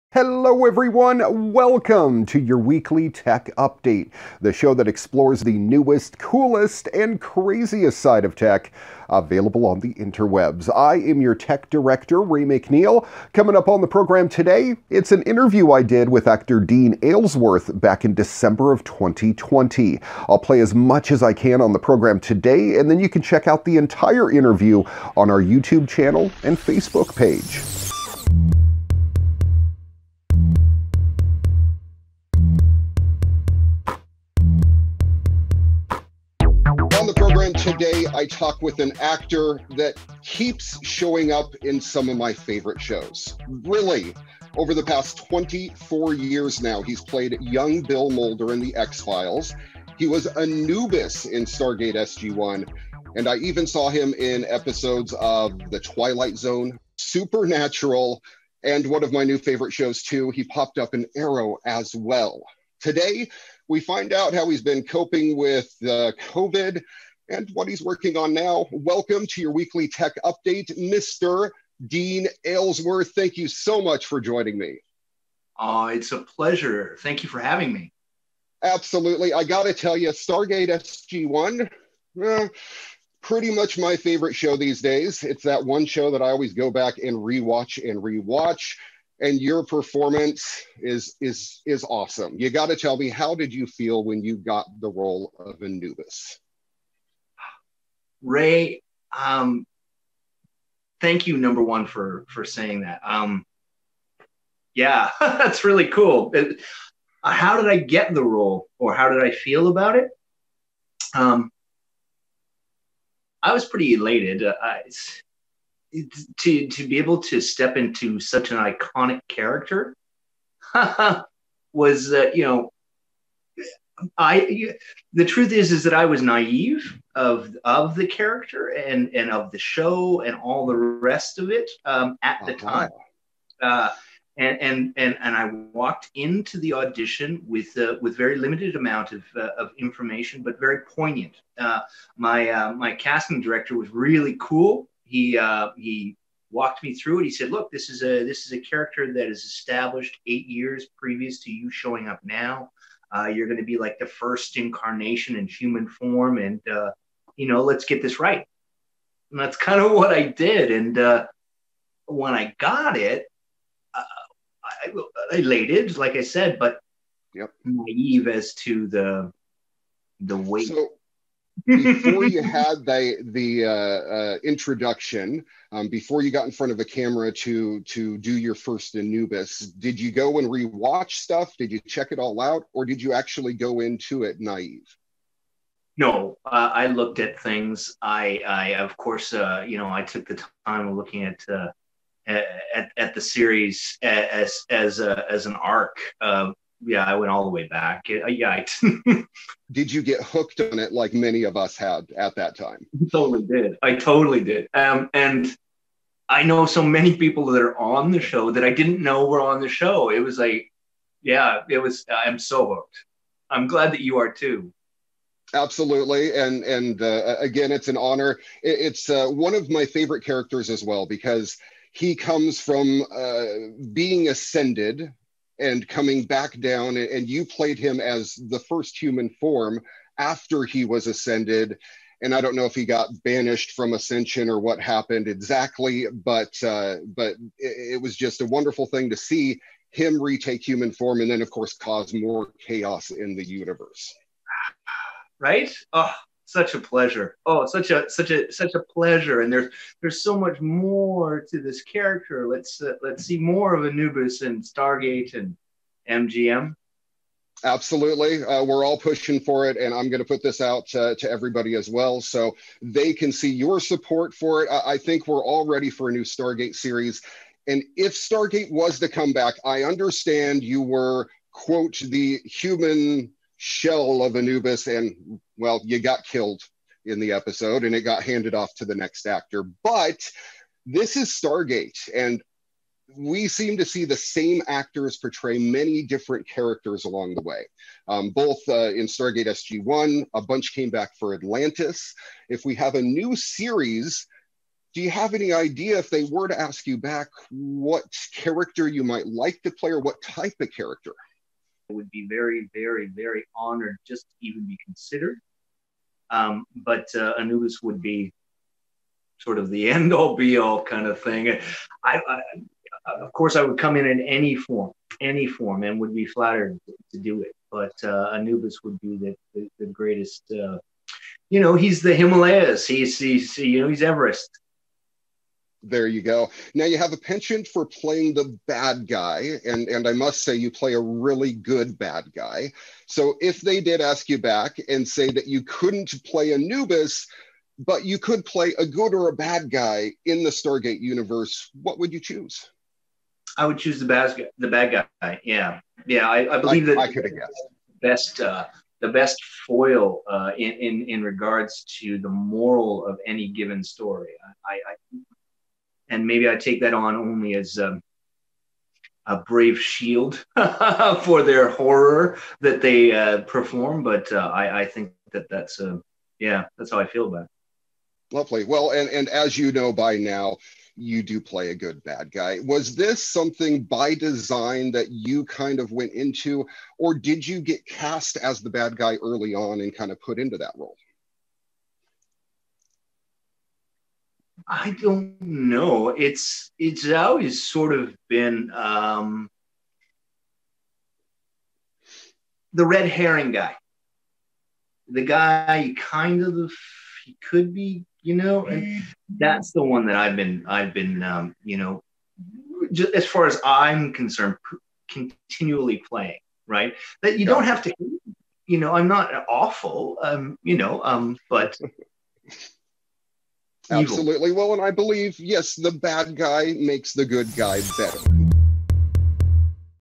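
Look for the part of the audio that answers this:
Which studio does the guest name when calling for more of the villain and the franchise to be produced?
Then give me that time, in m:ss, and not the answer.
4:16.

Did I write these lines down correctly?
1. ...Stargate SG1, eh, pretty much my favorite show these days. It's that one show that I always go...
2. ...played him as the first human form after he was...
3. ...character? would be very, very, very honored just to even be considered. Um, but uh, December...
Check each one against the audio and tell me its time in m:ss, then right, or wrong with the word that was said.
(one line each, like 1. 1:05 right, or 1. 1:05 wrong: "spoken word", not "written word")
1. 1:20 right
2. 3:47 right
3. 5:00 wrong: "Anubis", not "December".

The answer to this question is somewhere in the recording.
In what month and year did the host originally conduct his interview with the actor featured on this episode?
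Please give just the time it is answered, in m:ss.
0:18.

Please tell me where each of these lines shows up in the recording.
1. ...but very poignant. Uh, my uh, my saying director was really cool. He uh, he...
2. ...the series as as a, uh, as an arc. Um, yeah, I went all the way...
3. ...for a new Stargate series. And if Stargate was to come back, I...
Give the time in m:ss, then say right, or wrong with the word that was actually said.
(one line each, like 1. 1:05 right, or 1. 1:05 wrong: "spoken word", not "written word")
1. 2:20 wrong: "casting", not "saying"
2. 3:13 right
3. 4:25 right.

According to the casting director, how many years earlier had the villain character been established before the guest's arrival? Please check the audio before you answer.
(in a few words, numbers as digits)
8.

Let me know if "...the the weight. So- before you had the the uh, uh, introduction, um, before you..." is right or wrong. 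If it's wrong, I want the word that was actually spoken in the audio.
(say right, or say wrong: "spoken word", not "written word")
right.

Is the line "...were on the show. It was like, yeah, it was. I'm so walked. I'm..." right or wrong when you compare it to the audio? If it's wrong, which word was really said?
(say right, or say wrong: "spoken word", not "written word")
wrong: "hooked", not "walked".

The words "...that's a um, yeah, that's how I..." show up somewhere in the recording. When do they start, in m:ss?
6:05.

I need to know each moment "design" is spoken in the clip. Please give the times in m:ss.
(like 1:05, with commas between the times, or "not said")
6:14.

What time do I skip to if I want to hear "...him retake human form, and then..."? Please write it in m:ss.
3:59.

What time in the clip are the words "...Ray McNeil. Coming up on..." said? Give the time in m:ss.
0:12.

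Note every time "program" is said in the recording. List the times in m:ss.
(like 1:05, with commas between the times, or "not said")
0:13, 0:21.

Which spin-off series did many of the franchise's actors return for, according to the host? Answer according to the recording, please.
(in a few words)
Atlantis.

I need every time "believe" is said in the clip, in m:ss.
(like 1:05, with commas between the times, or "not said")
5:46, 6:54.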